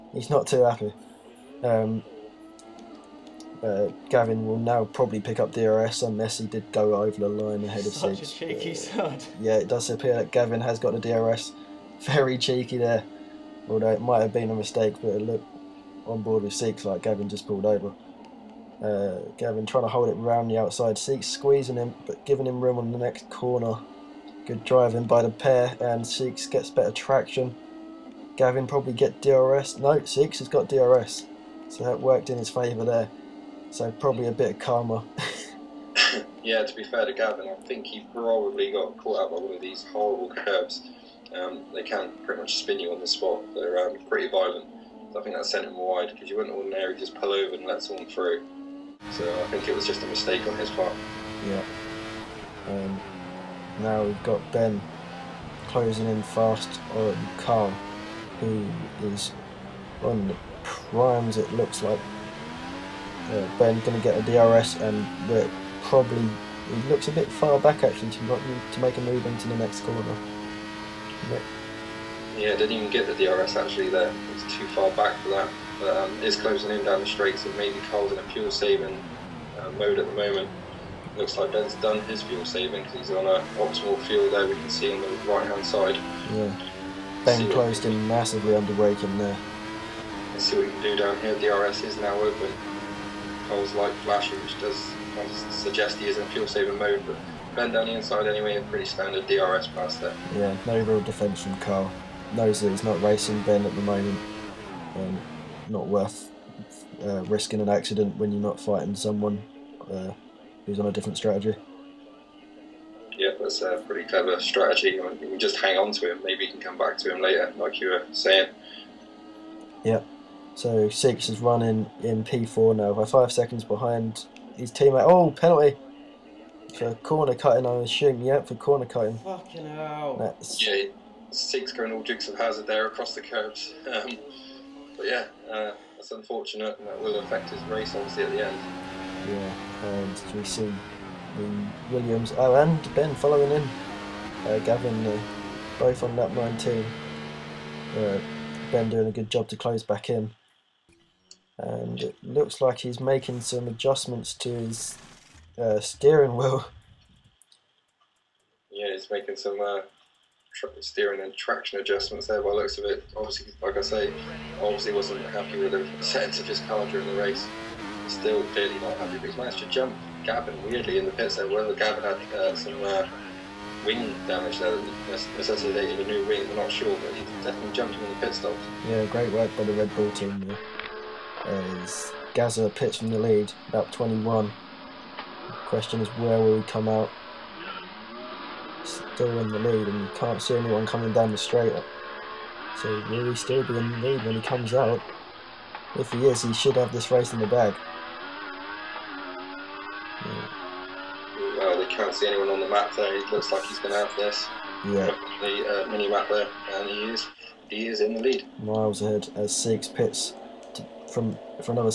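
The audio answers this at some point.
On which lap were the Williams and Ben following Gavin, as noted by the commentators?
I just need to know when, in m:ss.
2:26.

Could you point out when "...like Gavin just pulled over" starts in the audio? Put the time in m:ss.
0:16.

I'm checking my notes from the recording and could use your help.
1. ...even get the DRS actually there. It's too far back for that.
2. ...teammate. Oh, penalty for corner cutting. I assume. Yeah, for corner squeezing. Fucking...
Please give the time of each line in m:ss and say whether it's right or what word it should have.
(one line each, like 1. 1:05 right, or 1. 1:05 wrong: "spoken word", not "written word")
1. 1:12 right
2. 2:04 wrong: "cutting", not "squeezing".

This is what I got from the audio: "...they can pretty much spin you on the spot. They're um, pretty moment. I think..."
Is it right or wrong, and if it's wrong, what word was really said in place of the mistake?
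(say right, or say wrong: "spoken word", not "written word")
wrong: "violent", not "moment".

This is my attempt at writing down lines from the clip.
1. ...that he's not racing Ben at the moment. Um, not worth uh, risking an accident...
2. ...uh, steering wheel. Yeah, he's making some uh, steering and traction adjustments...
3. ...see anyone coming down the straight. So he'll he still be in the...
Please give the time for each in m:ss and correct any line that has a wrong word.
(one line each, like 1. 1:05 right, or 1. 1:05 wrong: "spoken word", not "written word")
1. 1:42 right
2. 2:35 right
3. 3:10 right.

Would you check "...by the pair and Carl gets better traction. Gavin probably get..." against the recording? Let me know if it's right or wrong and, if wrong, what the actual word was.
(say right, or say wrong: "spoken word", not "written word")
wrong: "Seeks", not "Carl".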